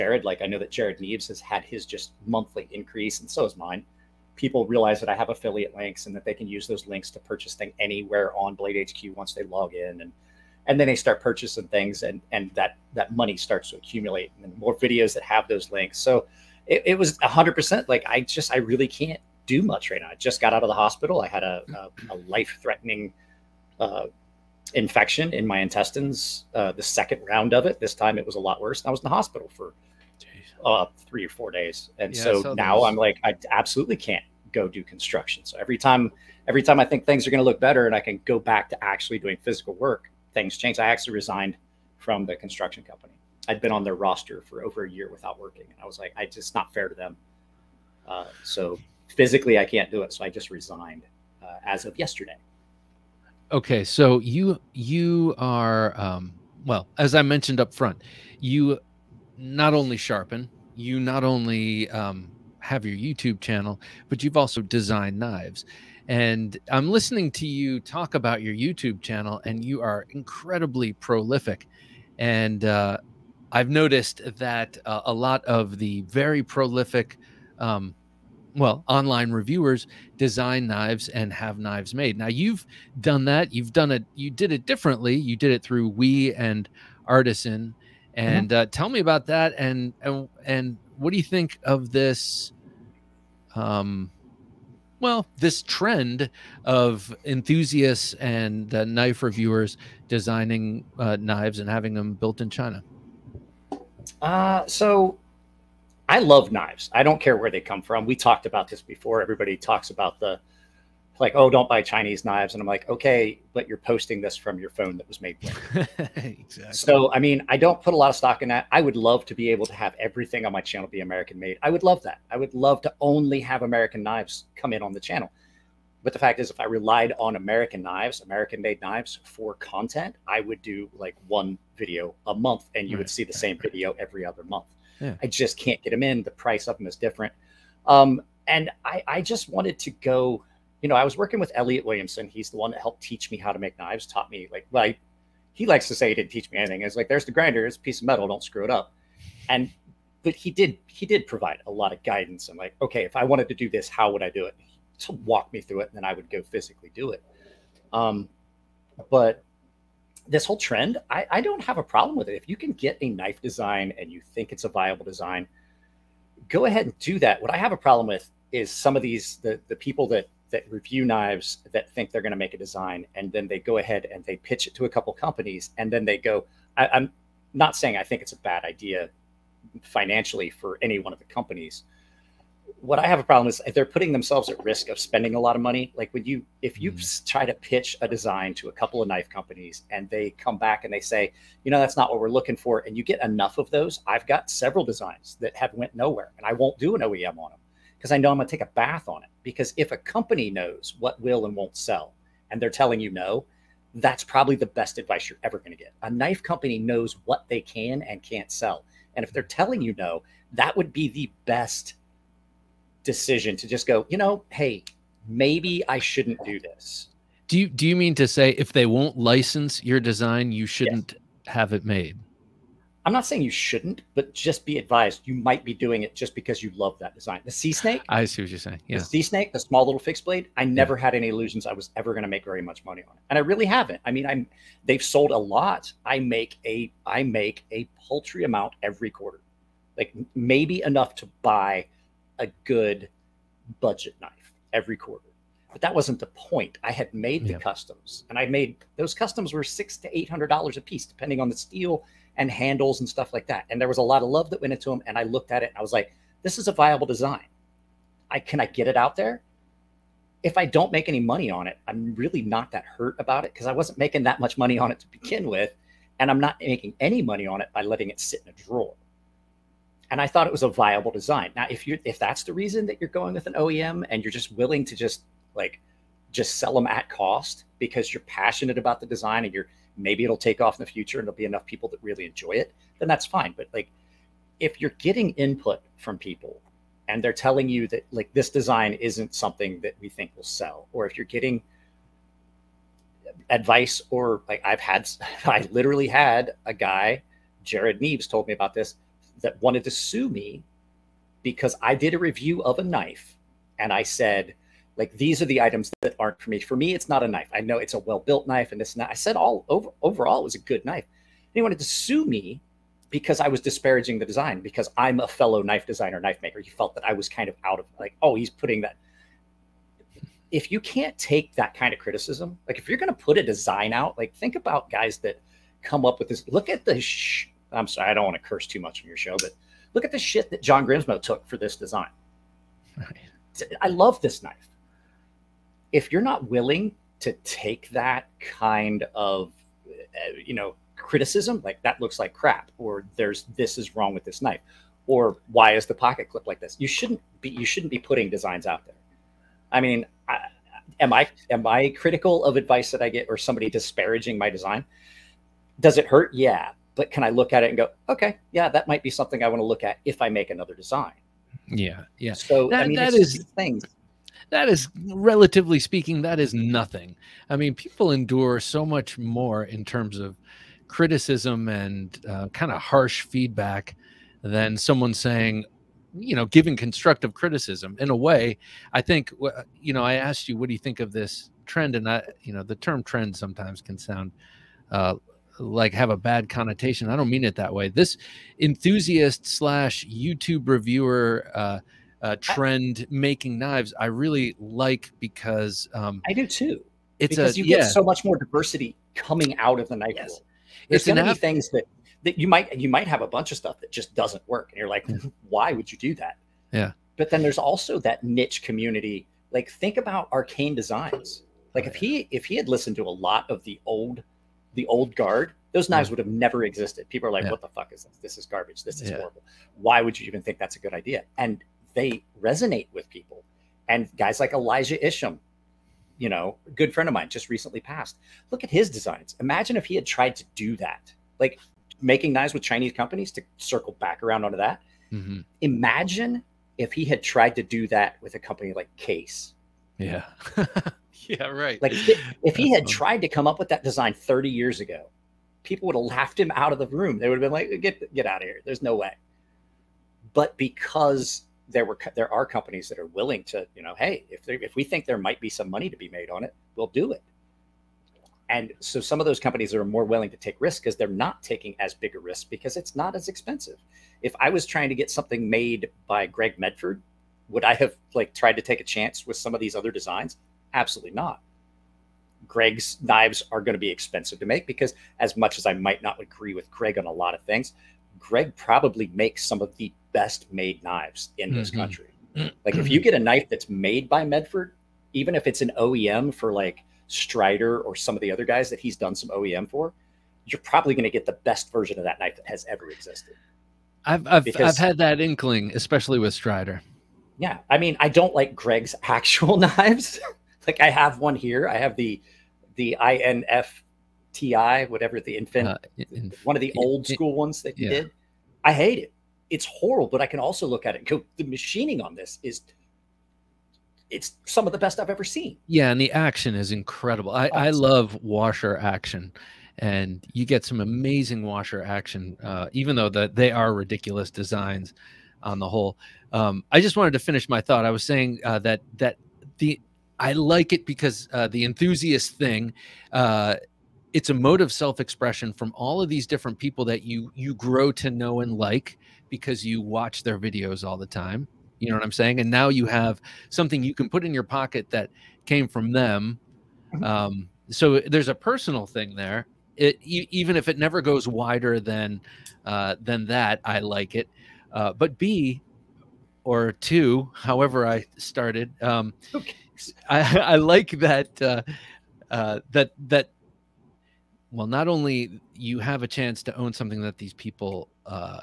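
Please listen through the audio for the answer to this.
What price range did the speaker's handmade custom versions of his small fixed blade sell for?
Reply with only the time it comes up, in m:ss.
4:09.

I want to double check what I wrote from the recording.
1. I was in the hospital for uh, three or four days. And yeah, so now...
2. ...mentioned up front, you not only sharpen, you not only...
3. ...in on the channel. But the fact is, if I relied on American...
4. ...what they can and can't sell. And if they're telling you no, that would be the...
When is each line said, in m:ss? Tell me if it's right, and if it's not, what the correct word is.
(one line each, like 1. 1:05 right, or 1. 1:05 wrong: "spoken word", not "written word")
1. 0:28 right
2. 0:57 right
3. 2:04 right
4. 3:27 right.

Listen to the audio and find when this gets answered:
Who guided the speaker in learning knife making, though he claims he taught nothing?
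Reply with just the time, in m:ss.
2:21.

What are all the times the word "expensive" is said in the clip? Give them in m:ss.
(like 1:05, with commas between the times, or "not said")
7:43, 7:53.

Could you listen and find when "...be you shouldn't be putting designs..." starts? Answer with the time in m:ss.
5:47.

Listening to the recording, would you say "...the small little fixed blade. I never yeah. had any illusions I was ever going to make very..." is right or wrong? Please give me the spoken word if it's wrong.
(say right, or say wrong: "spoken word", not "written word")
right.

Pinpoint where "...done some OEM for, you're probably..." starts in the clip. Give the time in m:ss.
8:08.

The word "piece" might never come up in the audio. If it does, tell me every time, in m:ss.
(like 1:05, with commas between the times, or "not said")
2:27, 4:10.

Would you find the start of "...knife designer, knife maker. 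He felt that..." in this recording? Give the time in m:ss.
5:15.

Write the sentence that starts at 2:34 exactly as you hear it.
To walk me through it, and then I would go physically do it.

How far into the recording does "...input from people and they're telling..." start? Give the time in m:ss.
4:45.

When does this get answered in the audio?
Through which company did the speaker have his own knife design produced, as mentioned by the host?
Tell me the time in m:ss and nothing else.
1:25.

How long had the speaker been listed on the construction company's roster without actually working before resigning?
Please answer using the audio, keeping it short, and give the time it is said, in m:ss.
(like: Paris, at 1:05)
Over a year, at 0:44.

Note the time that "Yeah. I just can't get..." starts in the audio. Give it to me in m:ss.
2:14.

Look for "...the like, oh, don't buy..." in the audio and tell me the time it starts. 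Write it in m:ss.
1:50.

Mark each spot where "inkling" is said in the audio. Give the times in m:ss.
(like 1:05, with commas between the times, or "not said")
8:15.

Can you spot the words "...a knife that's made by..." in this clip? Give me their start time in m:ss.
8:03.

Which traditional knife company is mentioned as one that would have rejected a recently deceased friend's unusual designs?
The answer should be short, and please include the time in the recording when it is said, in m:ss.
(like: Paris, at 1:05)
Case, at 7:18.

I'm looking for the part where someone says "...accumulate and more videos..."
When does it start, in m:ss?
0:13.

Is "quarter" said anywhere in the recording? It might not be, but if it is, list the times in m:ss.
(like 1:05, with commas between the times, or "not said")
3:59, 4:04.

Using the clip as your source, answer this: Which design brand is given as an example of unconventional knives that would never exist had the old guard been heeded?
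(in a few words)
Arcane Designs.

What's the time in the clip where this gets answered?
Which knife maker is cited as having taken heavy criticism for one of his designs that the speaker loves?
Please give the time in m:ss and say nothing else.
5:30.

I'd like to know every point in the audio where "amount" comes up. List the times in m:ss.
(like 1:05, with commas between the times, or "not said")
3:58.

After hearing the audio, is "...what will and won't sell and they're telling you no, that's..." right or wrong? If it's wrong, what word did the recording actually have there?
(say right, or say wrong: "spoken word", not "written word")
right.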